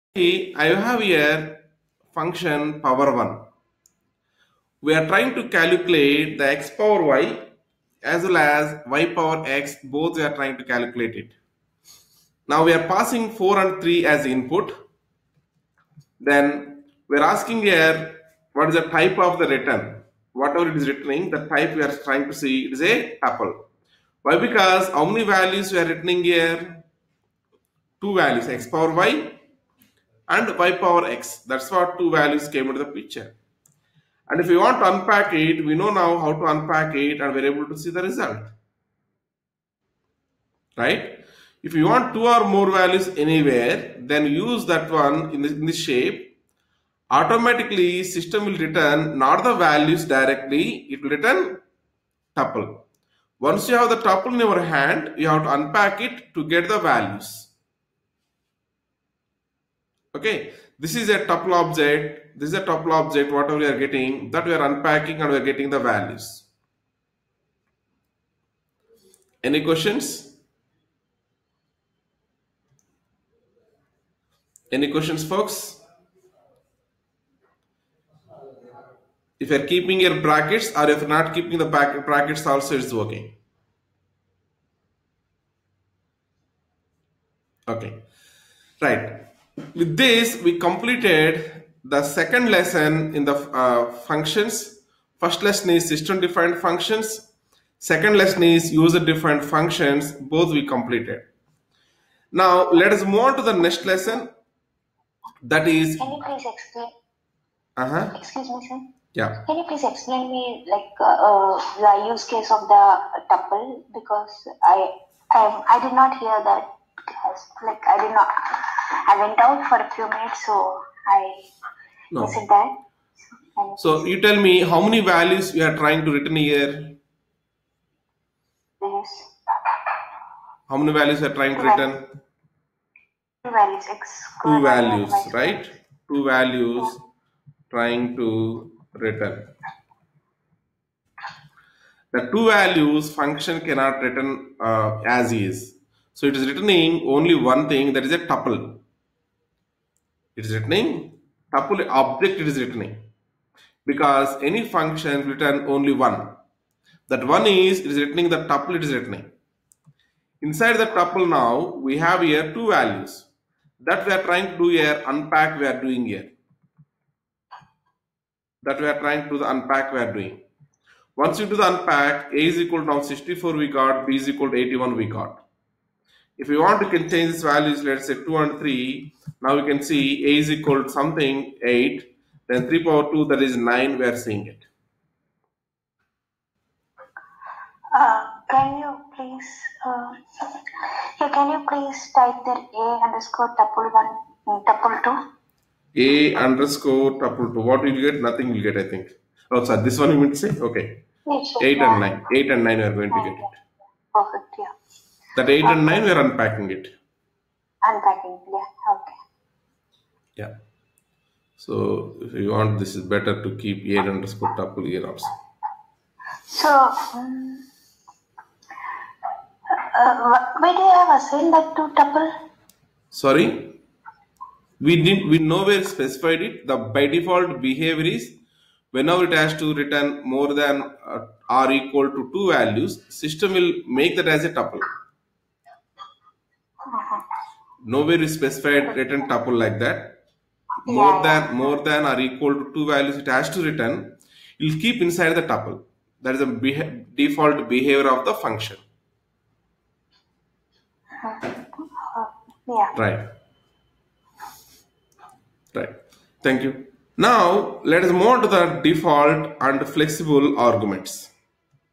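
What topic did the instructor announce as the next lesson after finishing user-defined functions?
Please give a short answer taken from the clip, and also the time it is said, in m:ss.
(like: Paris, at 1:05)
default and flexible arguments, at 4:18.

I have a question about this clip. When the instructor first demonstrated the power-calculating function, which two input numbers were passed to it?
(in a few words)
4 and 3.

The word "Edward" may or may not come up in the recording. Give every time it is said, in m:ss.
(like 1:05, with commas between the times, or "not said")
not said.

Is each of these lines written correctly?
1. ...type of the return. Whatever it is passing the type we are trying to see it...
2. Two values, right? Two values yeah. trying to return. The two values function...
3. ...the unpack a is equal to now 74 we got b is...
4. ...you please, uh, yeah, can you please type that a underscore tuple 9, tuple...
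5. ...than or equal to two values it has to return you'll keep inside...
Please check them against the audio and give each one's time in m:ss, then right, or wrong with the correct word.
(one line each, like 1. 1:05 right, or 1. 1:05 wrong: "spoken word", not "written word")
1. 0:18 wrong: "returning", not "passing"
2. 2:14 right
3. 2:51 wrong: "64", not "74"
4. 3:08 wrong: "1", not "9"
5. 4:01 right.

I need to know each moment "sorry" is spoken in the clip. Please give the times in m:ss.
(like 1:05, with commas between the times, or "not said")
3:19, 3:43.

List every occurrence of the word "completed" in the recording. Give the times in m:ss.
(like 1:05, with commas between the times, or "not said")
1:30, 1:40.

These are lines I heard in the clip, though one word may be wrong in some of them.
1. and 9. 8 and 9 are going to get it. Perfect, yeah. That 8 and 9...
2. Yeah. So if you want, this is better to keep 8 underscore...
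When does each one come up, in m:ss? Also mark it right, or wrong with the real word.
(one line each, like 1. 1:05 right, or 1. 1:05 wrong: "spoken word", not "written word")
1. 3:21 right
2. 3:30 right.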